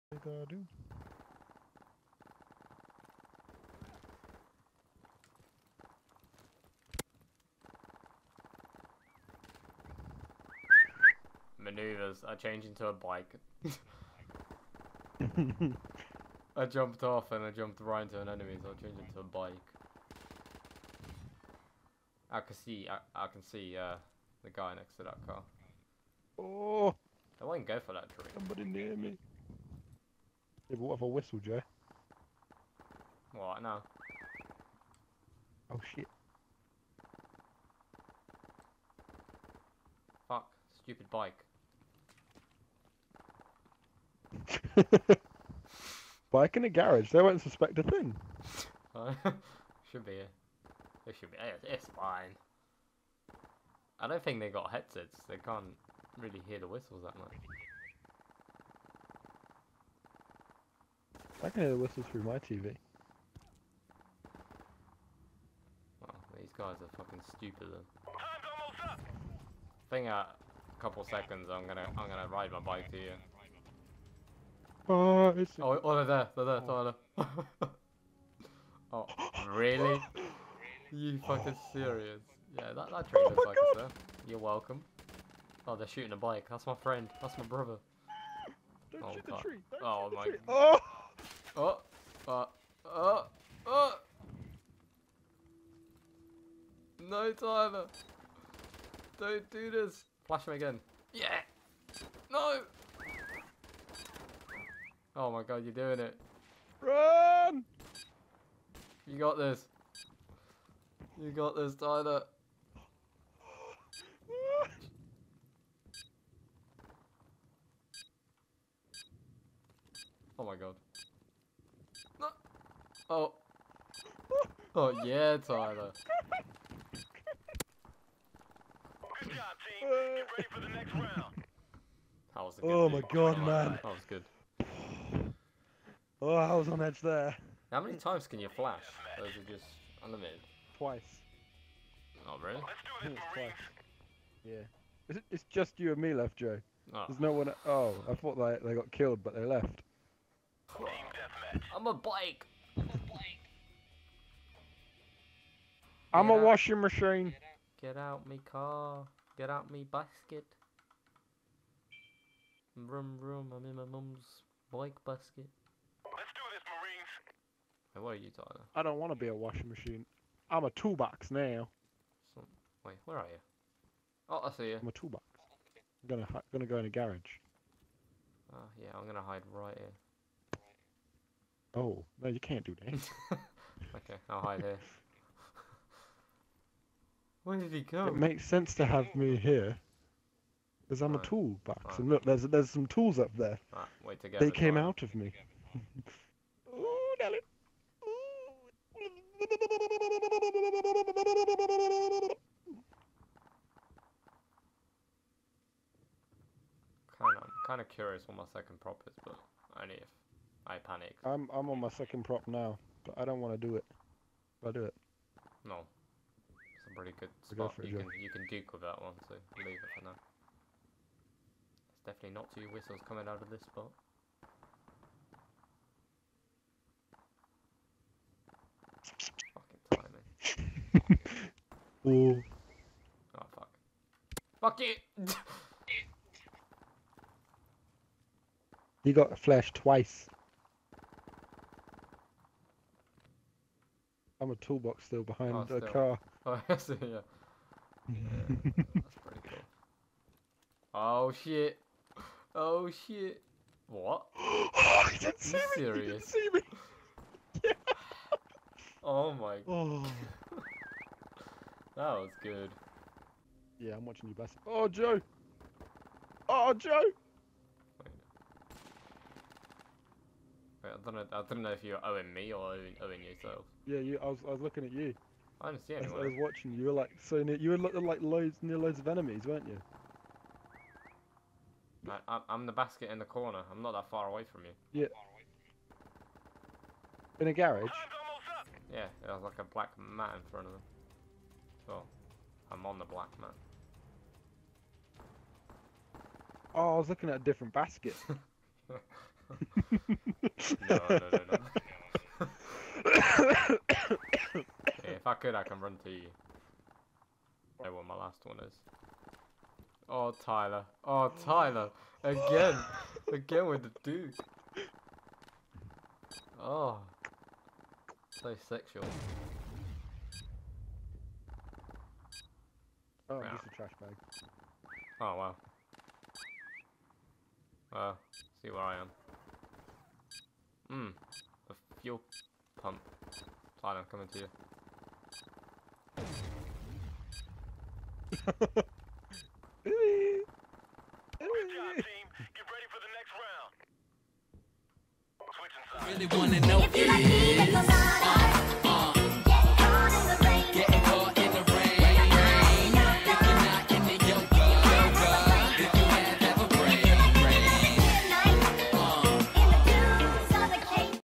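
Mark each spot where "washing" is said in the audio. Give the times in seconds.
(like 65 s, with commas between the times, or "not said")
156 s, 169 s.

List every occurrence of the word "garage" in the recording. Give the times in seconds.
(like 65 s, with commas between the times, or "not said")
46 s, 176 s, 287 s.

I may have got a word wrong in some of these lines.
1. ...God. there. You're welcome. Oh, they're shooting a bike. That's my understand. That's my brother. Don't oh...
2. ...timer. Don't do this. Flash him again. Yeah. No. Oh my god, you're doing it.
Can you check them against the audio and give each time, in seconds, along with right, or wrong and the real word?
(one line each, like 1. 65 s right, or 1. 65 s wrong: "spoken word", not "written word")
1. 83 s wrong: "friend", not "understand"
2. 97 s right.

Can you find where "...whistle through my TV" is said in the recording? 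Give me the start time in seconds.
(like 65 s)
61 s.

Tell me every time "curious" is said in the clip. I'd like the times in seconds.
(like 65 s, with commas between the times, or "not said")
207 s.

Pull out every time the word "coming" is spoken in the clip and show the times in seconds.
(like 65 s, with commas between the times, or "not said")
223 s.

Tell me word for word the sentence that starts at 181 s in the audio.
Oh no, you can't do that.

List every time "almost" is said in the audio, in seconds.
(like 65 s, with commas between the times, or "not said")
68 s.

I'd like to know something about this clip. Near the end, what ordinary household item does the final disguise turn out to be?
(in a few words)
A trash bag.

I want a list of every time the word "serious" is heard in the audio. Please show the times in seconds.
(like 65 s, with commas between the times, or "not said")
81 s, 255 s.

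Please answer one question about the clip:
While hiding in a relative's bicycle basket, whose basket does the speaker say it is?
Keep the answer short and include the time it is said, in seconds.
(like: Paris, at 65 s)
Mum, at 163 s.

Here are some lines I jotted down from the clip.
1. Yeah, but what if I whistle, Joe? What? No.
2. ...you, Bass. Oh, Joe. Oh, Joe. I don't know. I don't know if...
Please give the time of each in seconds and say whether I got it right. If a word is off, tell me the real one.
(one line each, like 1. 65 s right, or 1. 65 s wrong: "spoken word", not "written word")
1. 30 s right
2. 264 s right.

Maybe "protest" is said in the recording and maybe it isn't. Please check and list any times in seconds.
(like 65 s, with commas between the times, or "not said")
not said.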